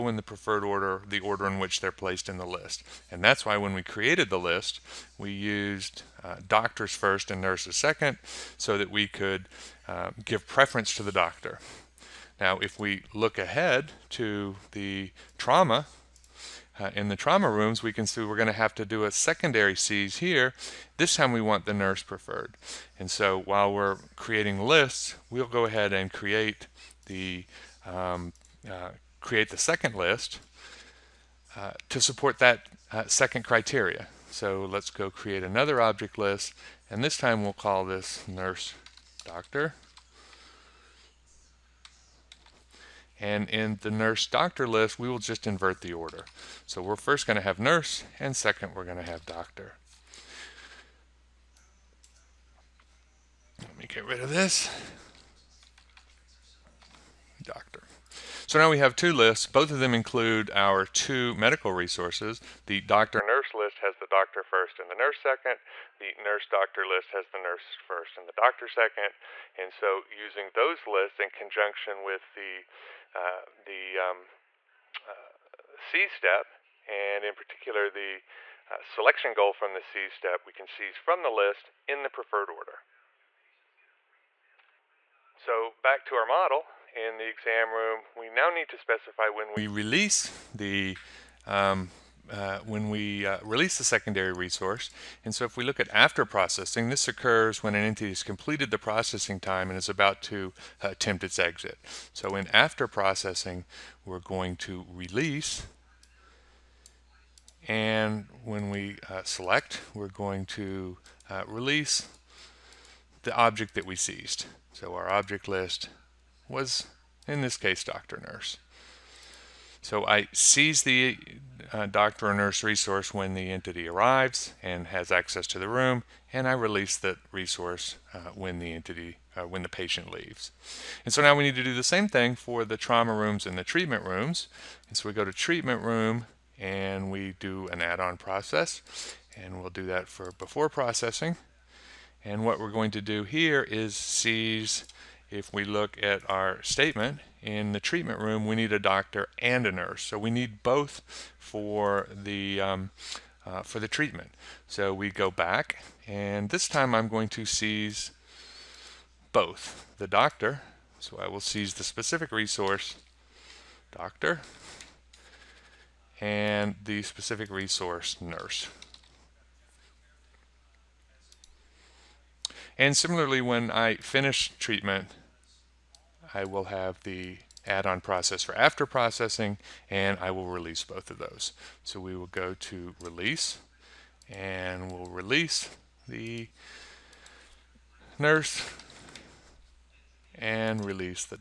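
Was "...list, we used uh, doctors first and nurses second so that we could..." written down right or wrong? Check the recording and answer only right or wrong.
right.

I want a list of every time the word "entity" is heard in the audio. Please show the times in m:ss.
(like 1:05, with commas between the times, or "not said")
1:37, 2:03, 2:08.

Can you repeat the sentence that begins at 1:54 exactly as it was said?
So our object list was, in this case, doctor nurse.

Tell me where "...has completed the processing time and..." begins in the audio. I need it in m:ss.
1:38.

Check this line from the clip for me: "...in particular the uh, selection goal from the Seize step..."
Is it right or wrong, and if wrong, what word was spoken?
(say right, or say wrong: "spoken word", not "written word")
right.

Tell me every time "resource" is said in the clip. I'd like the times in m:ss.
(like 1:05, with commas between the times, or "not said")
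1:01, 1:34, 2:02, 2:07, 2:42, 2:47.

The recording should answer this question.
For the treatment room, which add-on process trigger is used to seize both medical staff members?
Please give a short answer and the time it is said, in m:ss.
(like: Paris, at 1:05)
before processing, at 2:20.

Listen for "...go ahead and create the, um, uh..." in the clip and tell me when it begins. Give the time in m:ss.
0:25.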